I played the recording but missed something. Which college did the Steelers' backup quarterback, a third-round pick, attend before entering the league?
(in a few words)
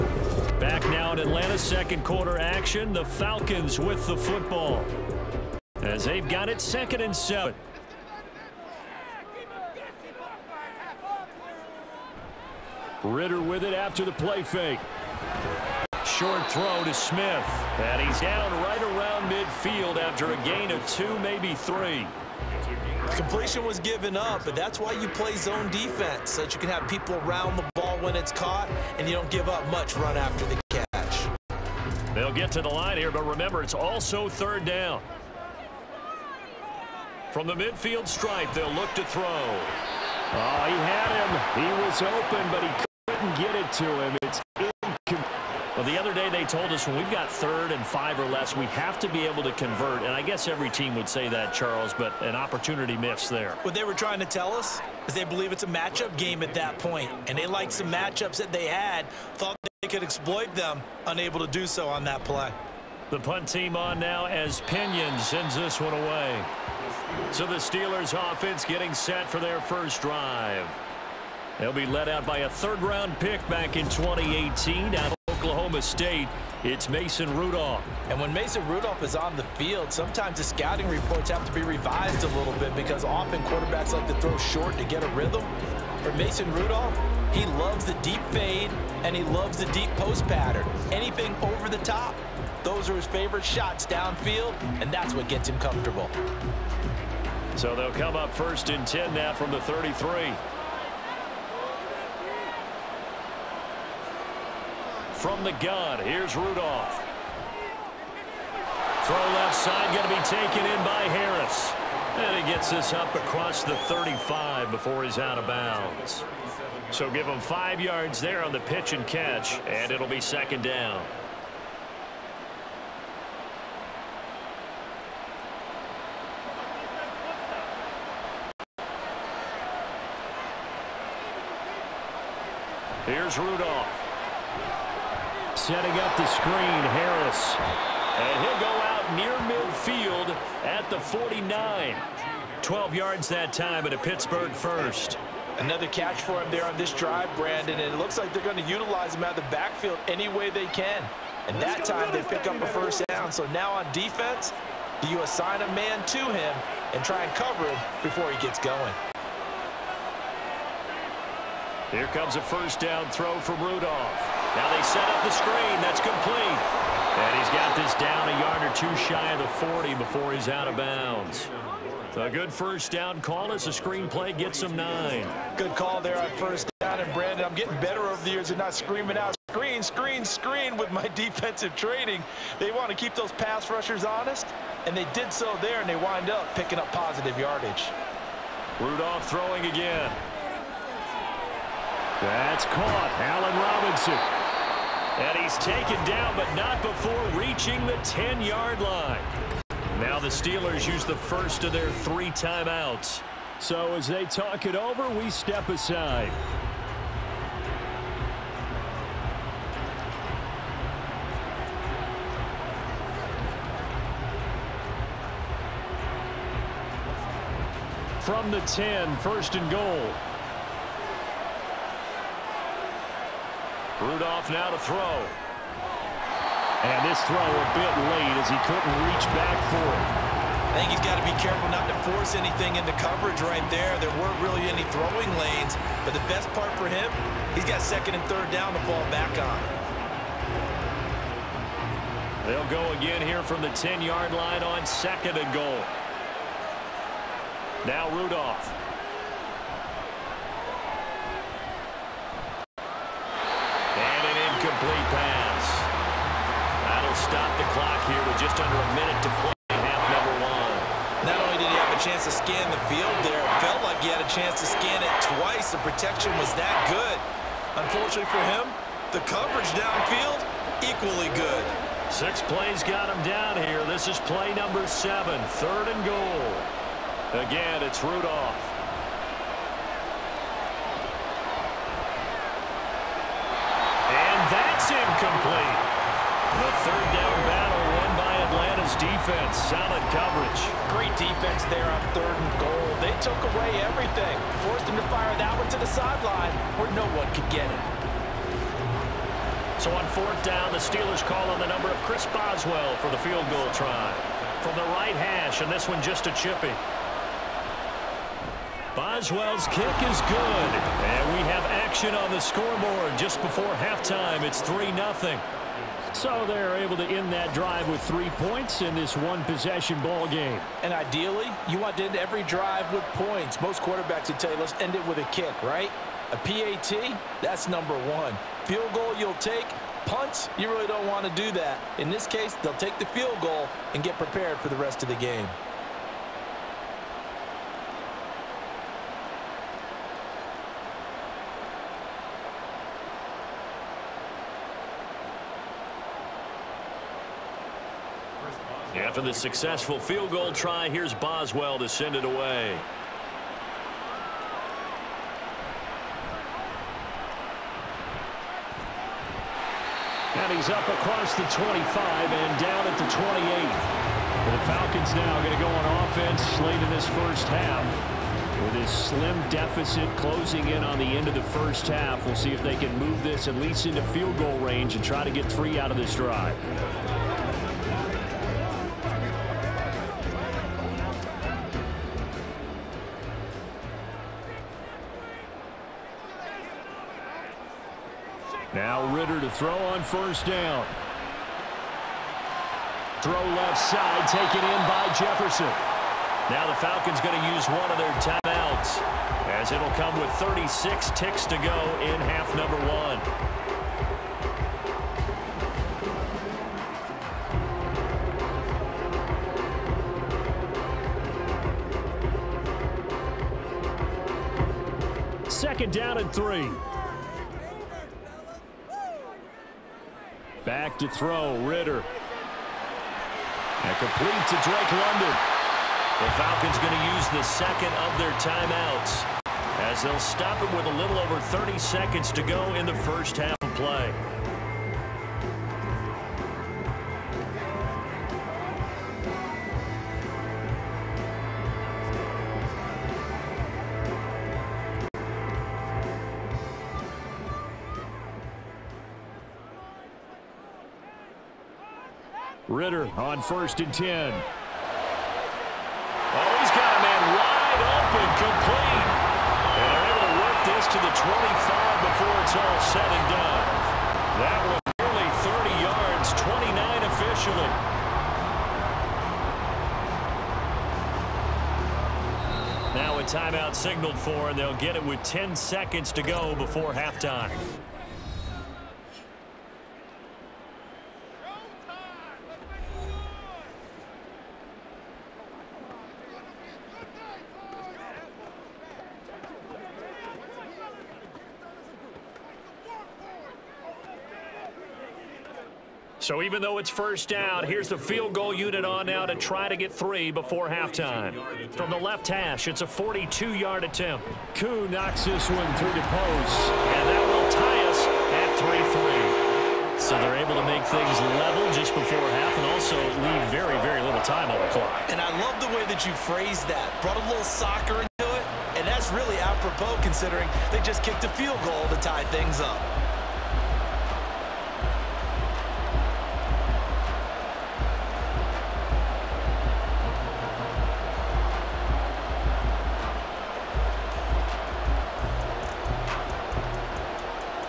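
Oklahoma State.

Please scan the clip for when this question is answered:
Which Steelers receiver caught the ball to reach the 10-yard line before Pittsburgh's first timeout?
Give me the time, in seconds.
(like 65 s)
193 s.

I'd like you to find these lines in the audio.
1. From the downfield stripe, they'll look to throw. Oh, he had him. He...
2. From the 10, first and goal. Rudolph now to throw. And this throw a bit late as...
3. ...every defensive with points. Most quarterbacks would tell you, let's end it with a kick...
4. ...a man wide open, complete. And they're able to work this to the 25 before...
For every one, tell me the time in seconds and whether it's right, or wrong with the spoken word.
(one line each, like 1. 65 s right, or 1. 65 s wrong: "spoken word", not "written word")
1. 37 s wrong: "midfield", not "downfield"
2. 218 s right
3. 322 s wrong: "drive", not "defensive"
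4. 456 s right.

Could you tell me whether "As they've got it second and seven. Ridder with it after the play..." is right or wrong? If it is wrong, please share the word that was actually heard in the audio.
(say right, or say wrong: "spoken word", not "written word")
right.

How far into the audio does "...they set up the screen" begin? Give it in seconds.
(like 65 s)
164 s.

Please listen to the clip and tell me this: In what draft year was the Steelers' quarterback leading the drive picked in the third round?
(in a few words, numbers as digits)
2018.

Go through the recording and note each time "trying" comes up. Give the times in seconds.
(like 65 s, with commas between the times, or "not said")
53 s.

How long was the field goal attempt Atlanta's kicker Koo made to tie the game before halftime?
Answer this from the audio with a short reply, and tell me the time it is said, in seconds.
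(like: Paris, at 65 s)
42 yards, at 502 s.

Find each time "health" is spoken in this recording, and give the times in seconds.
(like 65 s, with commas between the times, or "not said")
not said.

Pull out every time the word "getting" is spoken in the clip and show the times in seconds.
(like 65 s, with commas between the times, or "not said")
68 s, 177 s.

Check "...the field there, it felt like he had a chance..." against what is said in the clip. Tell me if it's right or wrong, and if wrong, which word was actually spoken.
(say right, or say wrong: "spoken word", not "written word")
right.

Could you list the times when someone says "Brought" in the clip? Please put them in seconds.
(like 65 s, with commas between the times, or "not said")
517 s.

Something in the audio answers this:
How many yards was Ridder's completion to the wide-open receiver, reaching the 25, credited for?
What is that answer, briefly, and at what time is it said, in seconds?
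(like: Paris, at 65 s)
29, at 466 s.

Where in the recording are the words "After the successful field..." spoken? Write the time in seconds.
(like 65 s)
349 s.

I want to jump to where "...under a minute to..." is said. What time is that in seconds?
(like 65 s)
258 s.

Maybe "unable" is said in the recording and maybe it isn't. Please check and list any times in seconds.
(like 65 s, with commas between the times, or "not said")
61 s.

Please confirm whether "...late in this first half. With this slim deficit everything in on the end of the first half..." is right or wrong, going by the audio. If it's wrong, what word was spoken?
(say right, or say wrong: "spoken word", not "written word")
wrong: "closing", not "everything".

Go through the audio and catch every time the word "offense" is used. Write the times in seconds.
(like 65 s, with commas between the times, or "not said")
68 s, 366 s.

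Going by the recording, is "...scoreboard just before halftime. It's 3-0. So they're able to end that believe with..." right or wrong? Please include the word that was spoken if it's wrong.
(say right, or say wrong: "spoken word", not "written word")
wrong: "drive", not "believe".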